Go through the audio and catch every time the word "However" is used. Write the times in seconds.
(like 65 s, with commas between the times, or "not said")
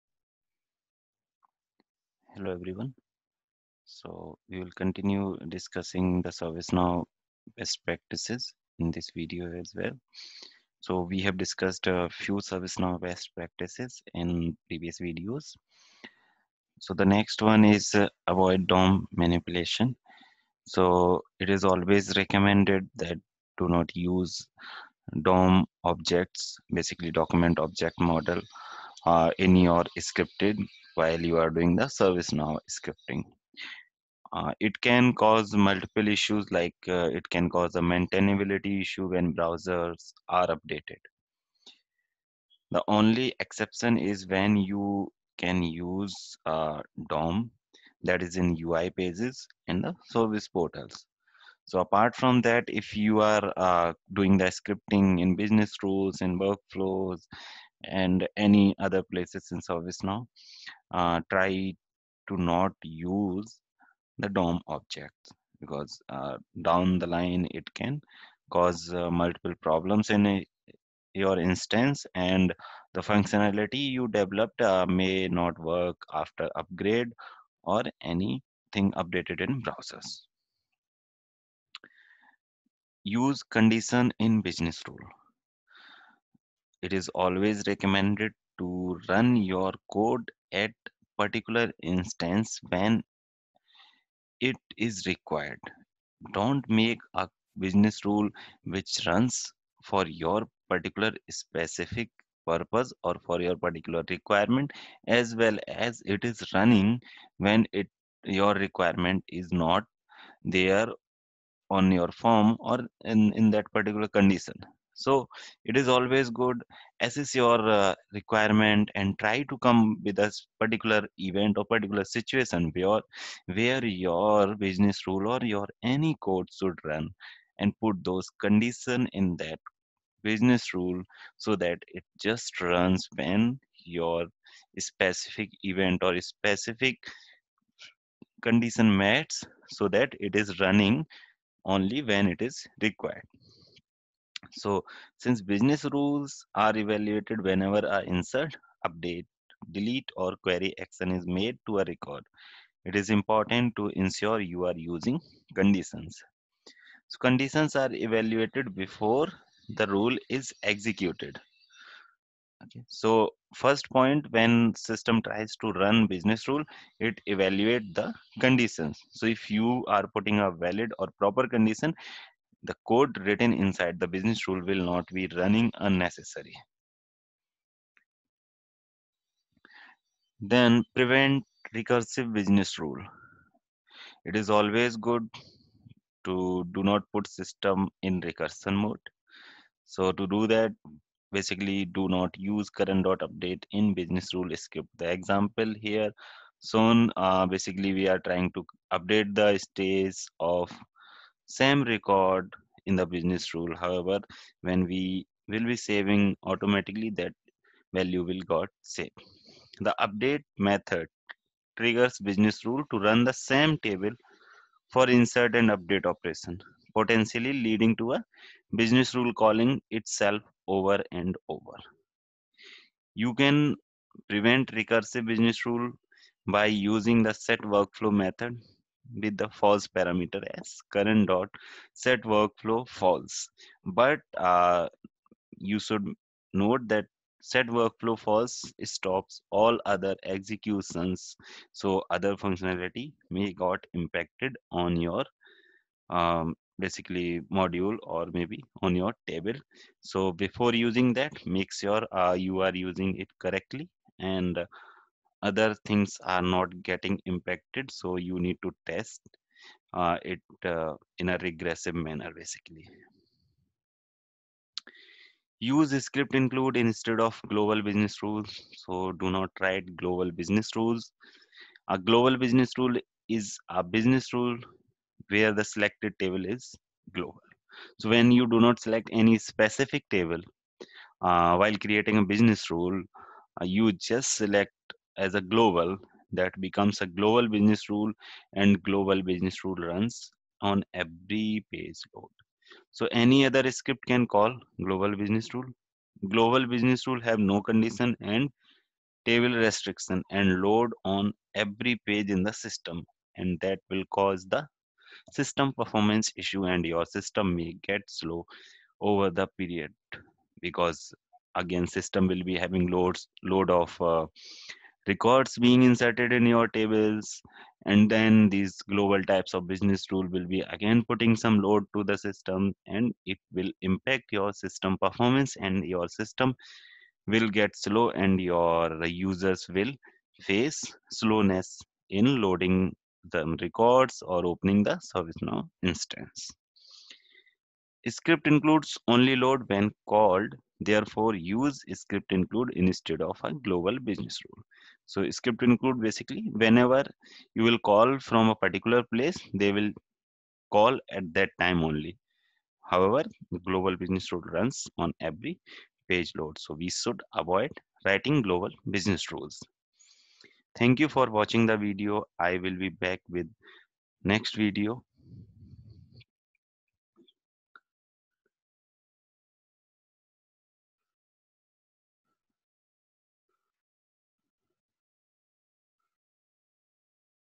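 203 s, 352 s.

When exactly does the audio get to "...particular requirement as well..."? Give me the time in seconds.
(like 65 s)
103 s.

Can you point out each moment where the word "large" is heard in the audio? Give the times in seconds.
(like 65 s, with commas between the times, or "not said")
not said.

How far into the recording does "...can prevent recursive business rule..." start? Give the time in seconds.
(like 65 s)
223 s.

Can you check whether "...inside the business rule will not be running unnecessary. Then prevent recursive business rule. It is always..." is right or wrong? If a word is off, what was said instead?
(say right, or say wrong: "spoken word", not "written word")
right.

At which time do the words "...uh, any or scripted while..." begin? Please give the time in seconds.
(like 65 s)
29 s.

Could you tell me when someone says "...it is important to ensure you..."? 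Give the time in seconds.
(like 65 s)
152 s.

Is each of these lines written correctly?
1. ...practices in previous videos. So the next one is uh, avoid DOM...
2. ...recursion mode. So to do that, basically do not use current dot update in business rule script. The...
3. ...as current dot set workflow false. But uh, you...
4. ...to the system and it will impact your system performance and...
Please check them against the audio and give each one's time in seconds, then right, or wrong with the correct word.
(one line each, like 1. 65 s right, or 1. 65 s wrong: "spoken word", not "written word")
1. 13 s right
2. 188 s right
3. 230 s right
4. 321 s right.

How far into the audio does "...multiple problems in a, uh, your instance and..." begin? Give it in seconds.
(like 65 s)
69 s.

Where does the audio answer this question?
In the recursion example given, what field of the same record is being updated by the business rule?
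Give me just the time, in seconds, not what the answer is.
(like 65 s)
199 s.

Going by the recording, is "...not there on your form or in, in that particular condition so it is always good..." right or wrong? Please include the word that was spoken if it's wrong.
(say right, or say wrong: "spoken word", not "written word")
right.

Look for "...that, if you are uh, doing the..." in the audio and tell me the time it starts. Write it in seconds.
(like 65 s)
52 s.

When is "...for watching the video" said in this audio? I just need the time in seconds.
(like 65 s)
361 s.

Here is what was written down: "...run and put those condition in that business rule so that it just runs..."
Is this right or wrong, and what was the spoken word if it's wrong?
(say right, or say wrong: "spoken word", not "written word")
right.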